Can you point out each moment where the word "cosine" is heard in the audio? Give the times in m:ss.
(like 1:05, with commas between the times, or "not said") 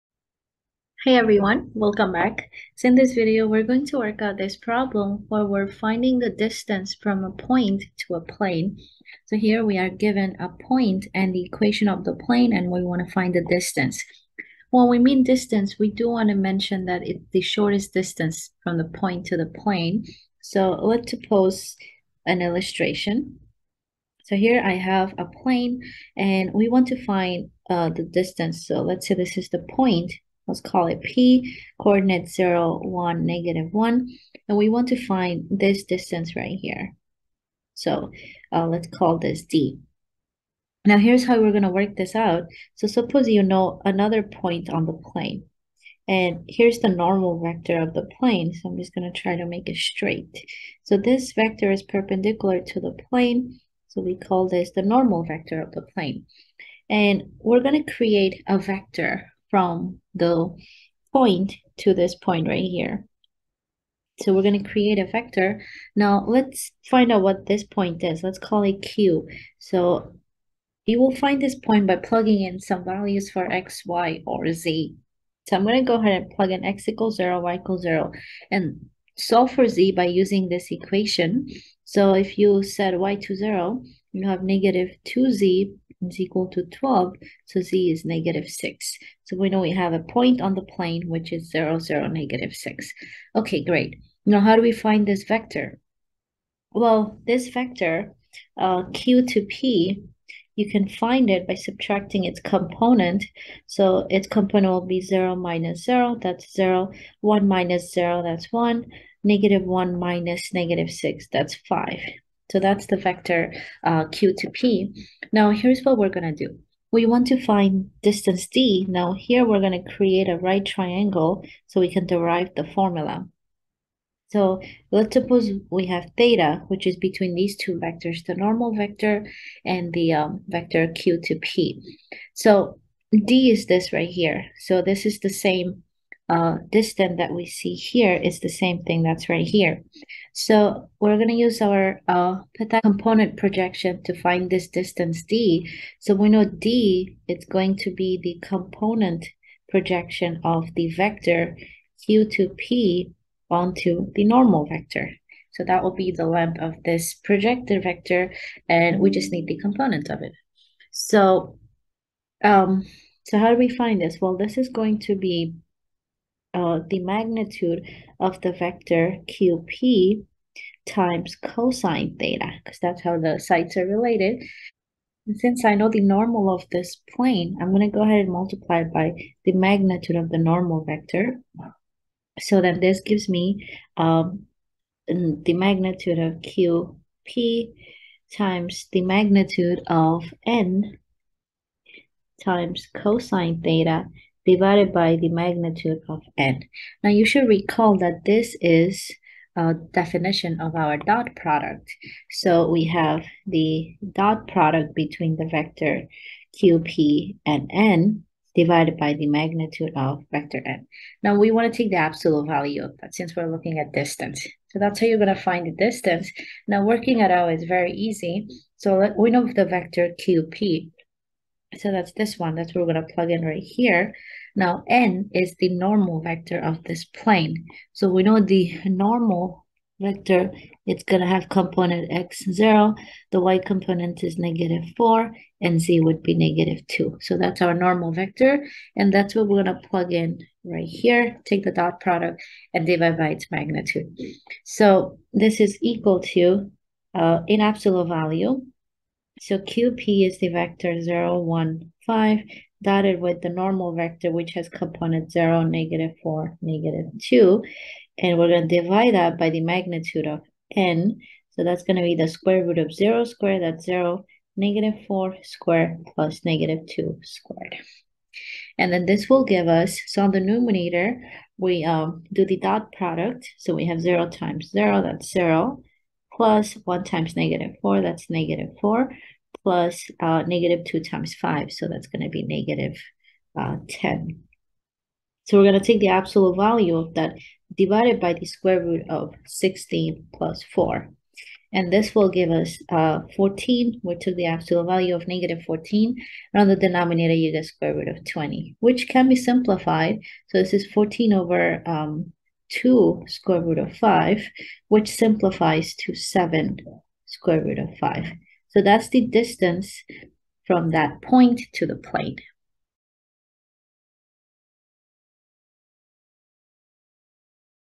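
2:51, 3:12.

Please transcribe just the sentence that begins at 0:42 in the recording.
So suppose you know another point on the plane.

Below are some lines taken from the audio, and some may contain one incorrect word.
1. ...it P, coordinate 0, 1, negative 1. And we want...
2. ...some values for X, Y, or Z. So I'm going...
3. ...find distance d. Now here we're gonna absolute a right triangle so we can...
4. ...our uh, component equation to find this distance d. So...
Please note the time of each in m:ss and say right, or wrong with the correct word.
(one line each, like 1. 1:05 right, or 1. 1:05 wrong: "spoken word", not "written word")
1. 0:30 right
2. 1:12 right
3. 1:57 wrong: "create", not "absolute"
4. 2:21 wrong: "projection", not "equation".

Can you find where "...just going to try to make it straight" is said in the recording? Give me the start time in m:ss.
0:48.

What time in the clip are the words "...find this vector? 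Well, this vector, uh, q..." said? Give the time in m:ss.
1:34.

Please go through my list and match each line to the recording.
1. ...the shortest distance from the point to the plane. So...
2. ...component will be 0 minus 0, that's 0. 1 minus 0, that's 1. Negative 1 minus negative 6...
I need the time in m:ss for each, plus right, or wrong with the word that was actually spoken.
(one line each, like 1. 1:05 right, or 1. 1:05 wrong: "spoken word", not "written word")
1. 0:17 right
2. 1:44 right.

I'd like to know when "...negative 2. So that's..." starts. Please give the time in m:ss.
3:56.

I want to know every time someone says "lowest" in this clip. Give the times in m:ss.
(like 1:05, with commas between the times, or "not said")
not said.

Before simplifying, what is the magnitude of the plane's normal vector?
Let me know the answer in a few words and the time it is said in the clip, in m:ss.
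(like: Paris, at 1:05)
square root of 20, at 4:57.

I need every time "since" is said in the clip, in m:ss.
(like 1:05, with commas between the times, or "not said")
2:55, 3:33.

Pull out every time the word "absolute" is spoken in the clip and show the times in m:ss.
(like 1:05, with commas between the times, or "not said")
3:31, 4:07, 4:46, 4:54.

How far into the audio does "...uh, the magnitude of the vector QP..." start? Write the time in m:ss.
2:46.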